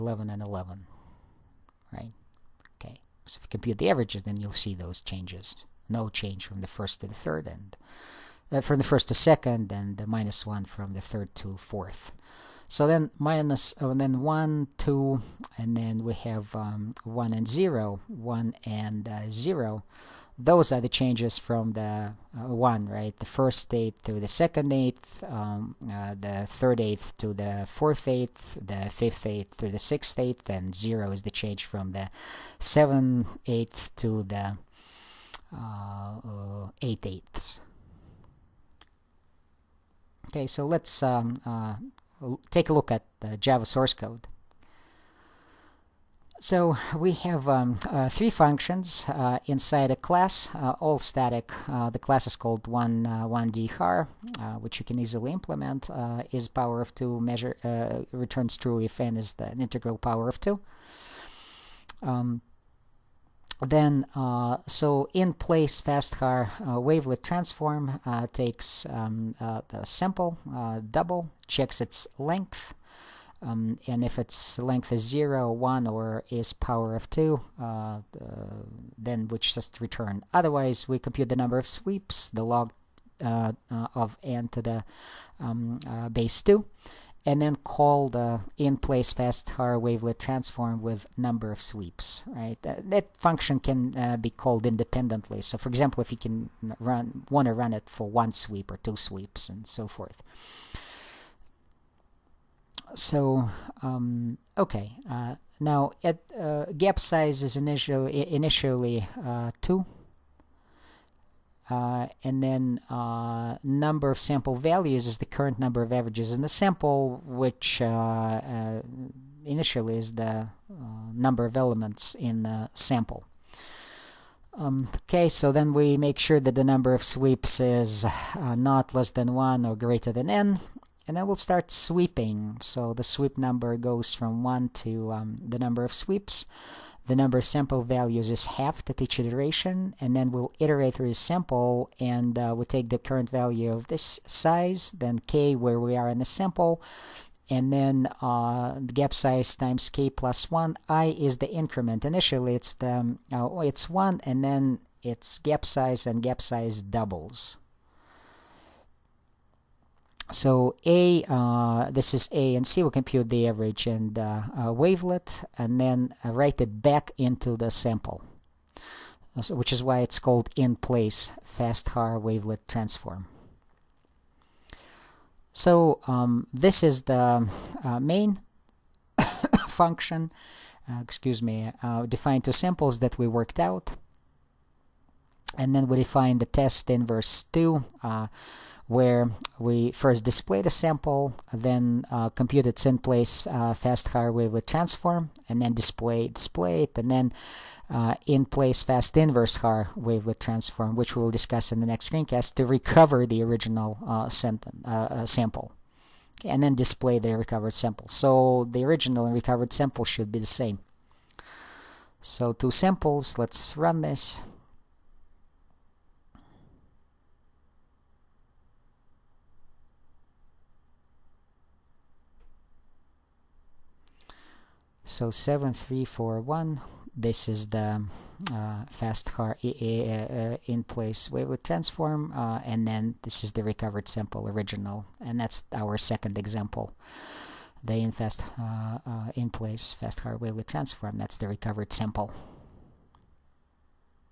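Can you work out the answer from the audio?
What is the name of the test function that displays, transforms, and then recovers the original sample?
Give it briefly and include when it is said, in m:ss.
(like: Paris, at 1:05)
test inverse 2, at 3:06.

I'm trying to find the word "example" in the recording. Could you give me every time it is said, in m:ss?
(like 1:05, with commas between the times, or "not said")
1:35, 3:56.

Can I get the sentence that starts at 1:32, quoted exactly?
that function can uh, be called independently.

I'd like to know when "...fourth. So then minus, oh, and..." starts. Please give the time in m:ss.
0:11.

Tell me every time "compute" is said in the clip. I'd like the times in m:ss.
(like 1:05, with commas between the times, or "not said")
0:03, 1:20, 2:42, 3:12.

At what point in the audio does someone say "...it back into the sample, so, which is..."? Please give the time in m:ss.
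2:46.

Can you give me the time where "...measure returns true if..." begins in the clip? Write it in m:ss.
0:57.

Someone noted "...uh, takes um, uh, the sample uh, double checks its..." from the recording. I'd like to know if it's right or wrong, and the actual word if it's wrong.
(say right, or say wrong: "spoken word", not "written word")
right.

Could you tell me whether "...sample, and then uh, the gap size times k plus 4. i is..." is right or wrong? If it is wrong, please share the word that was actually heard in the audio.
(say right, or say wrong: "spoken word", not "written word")
wrong: "1", not "4".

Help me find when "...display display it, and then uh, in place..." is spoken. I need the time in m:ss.
3:15.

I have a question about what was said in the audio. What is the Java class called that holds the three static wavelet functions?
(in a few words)
one one.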